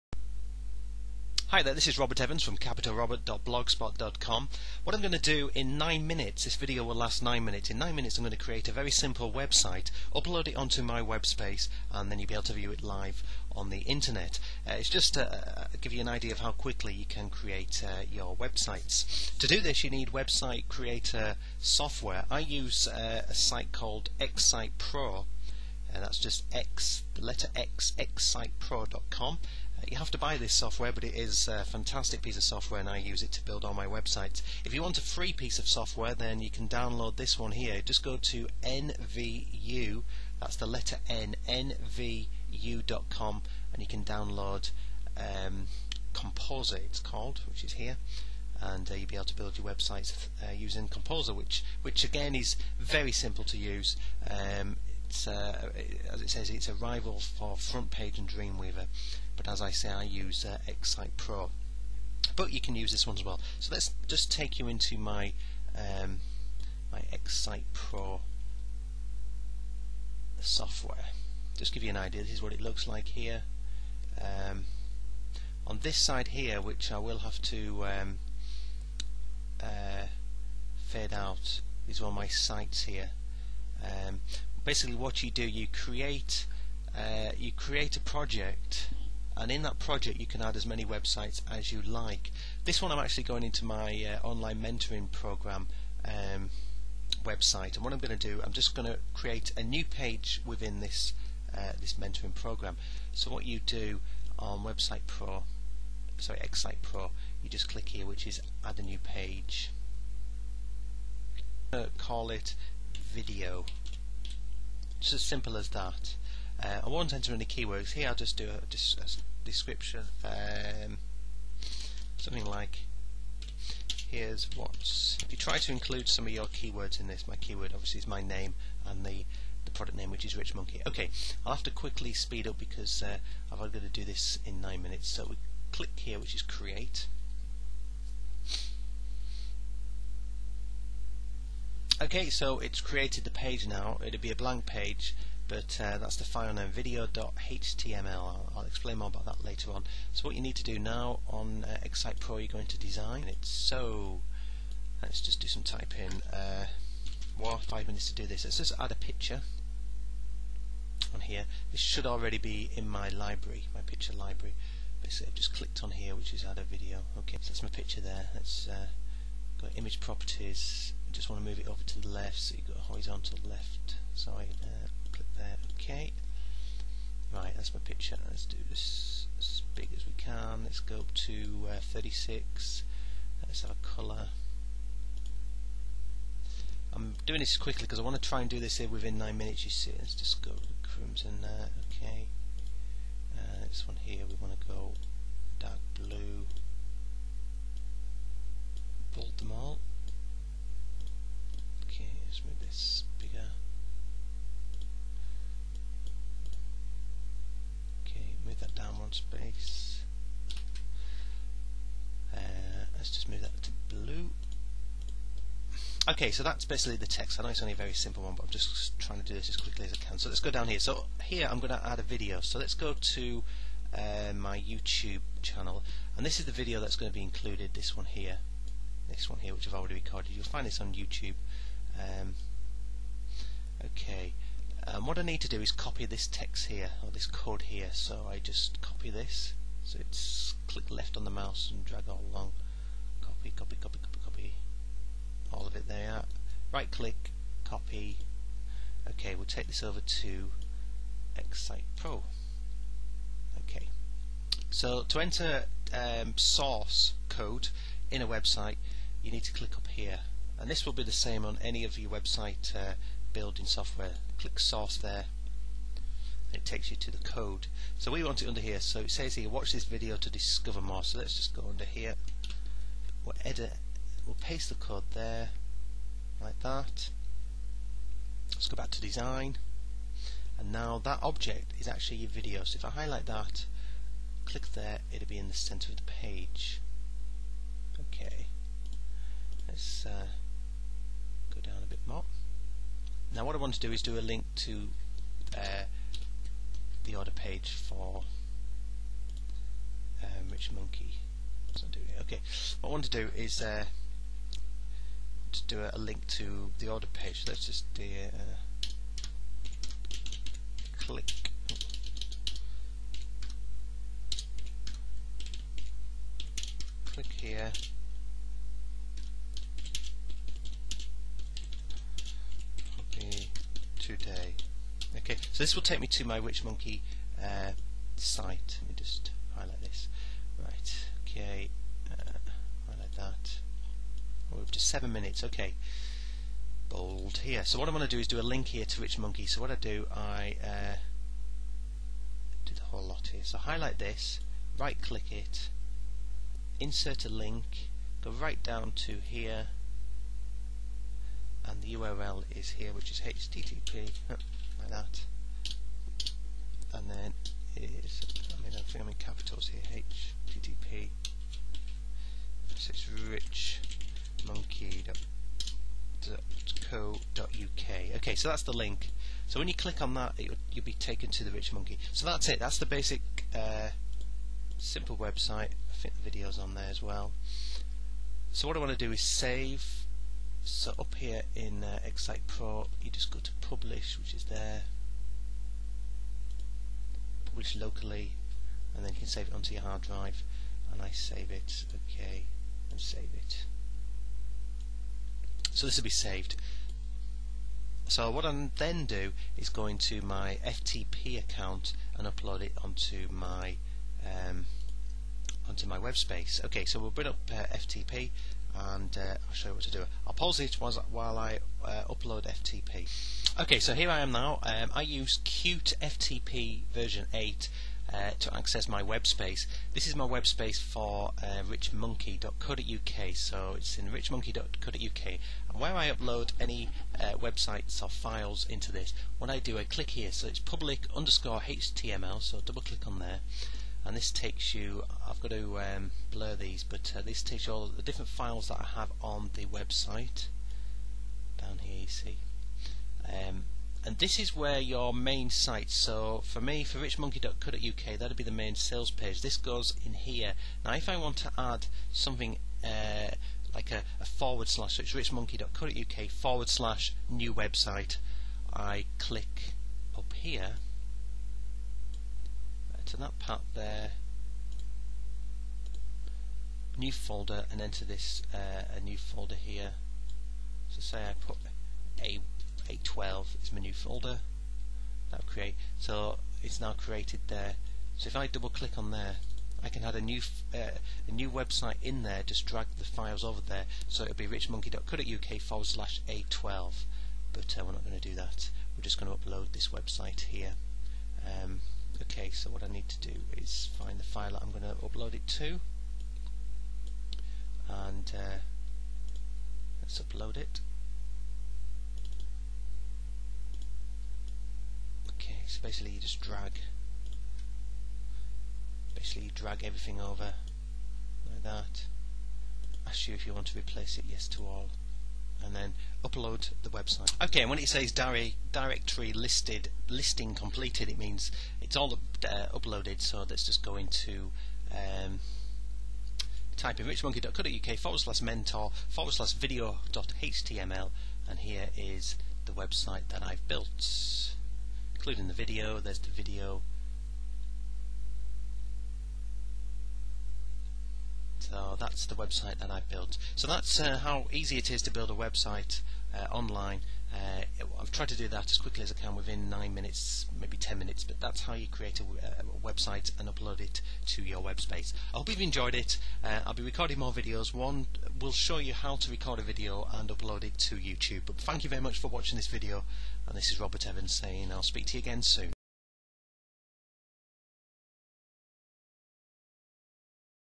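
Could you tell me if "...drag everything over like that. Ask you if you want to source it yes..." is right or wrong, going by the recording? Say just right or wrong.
wrong.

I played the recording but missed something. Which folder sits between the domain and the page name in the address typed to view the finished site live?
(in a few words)
mentor.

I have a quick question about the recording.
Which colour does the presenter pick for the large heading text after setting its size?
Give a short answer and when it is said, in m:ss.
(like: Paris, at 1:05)
crimson, at 3:10.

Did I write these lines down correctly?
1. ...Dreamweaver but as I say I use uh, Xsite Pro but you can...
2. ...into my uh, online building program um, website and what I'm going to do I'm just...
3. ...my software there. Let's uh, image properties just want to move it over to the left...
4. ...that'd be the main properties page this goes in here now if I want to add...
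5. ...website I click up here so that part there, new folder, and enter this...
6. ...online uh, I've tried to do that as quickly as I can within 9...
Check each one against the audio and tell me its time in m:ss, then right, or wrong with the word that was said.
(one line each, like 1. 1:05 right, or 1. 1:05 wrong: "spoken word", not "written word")
1. 0:58 right
2. 1:33 wrong: "mentoring", not "building"
3. 2:47 wrong: "picture", not "software"
4. 7:28 wrong: "sales", not "properties"
5. 7:37 right
6. 9:06 right.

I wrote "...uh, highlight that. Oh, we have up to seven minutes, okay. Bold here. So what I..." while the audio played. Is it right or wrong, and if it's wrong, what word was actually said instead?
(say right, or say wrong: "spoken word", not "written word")
right.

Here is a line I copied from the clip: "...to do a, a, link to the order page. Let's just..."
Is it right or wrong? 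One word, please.
right.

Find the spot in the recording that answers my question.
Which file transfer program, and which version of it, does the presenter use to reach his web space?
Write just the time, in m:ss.
6:55.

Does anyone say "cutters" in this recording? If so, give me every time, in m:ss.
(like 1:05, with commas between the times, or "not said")
not said.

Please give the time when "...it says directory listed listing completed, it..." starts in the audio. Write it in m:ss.
8:37.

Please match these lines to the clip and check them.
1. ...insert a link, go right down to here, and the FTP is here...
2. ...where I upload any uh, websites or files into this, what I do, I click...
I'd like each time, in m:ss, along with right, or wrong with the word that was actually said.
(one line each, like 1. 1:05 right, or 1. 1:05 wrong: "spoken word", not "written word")
1. 5:46 wrong: "URL", not "FTP"
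2. 7:05 right.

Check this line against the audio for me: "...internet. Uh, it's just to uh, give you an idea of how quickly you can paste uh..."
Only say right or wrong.
wrong.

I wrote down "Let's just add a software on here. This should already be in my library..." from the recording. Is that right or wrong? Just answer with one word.
wrong.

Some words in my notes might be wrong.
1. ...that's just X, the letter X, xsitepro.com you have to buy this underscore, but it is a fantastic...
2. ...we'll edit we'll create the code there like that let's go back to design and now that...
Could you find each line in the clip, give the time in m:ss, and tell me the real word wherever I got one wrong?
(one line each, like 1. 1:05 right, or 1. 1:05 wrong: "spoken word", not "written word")
1. 0:25 wrong: "software", not "underscore"
2. 4:33 wrong: "paste", not "create".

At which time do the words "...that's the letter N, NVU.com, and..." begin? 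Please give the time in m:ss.
0:40.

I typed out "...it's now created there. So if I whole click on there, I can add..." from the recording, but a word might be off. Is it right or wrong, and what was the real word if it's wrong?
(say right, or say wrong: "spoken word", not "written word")
wrong: "double", not "whole".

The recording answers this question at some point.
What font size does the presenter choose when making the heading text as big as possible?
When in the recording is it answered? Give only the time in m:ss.
3:01.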